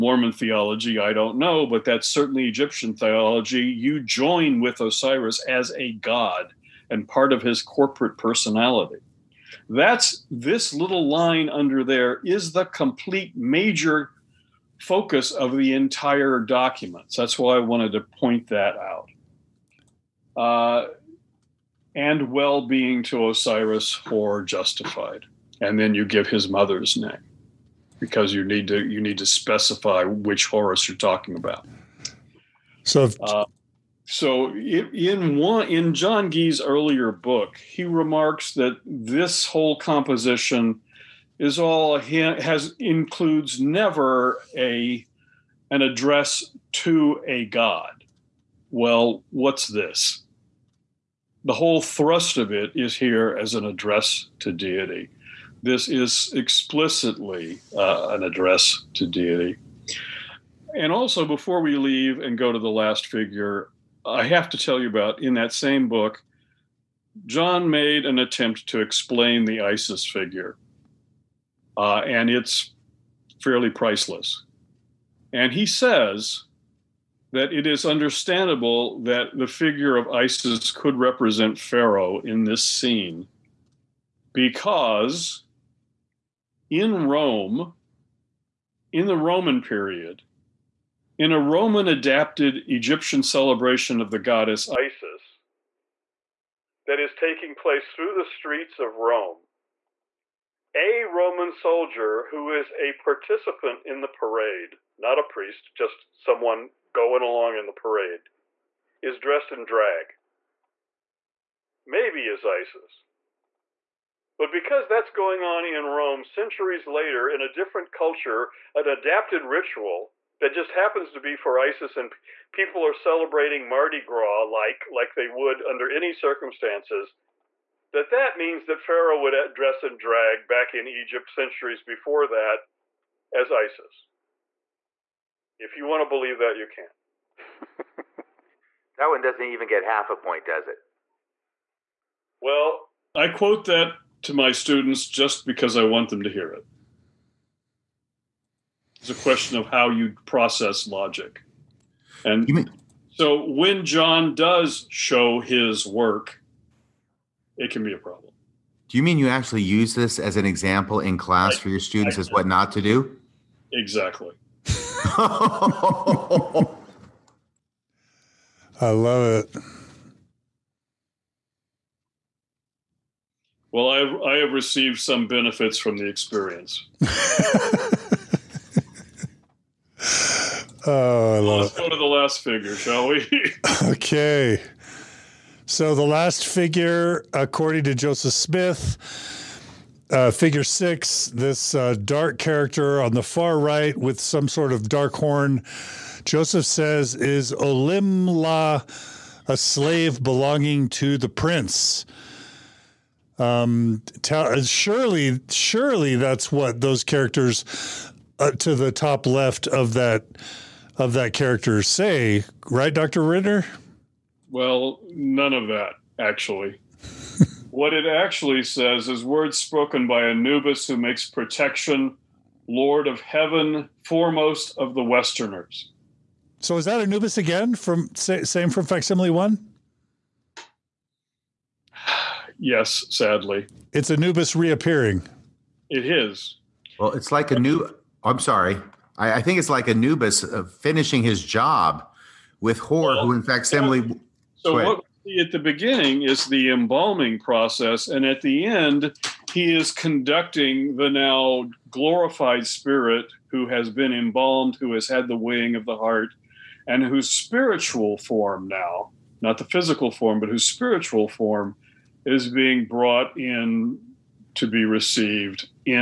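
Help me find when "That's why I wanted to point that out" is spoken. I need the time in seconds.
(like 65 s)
17 s.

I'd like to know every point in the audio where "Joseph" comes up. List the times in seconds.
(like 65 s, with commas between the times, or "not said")
187 s, 196 s.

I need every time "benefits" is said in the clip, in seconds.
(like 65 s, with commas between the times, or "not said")
175 s.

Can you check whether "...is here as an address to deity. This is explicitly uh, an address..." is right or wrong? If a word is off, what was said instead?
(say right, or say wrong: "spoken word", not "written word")
right.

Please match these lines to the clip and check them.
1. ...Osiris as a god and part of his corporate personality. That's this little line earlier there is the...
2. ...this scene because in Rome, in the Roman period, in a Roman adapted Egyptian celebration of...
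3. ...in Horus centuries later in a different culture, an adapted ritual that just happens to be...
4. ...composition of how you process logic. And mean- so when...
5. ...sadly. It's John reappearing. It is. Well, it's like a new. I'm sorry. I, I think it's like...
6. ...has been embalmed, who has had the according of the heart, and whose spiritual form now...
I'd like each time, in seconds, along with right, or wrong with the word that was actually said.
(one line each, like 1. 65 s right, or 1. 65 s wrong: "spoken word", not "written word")
1. 4 s wrong: "under", not "earlier"
2. 82 s right
3. 115 s wrong: "Rome", not "Horus"
4. 149 s wrong: "question", not "composition"
5. 233 s wrong: "Anubis", not "John"
6. 253 s wrong: "weighing", not "according".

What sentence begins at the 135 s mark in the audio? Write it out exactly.
If you want to believe that, you can.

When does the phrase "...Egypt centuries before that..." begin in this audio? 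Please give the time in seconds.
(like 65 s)
130 s.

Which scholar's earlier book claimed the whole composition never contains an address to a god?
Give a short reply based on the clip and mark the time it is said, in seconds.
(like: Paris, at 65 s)
John Gee, at 35 s.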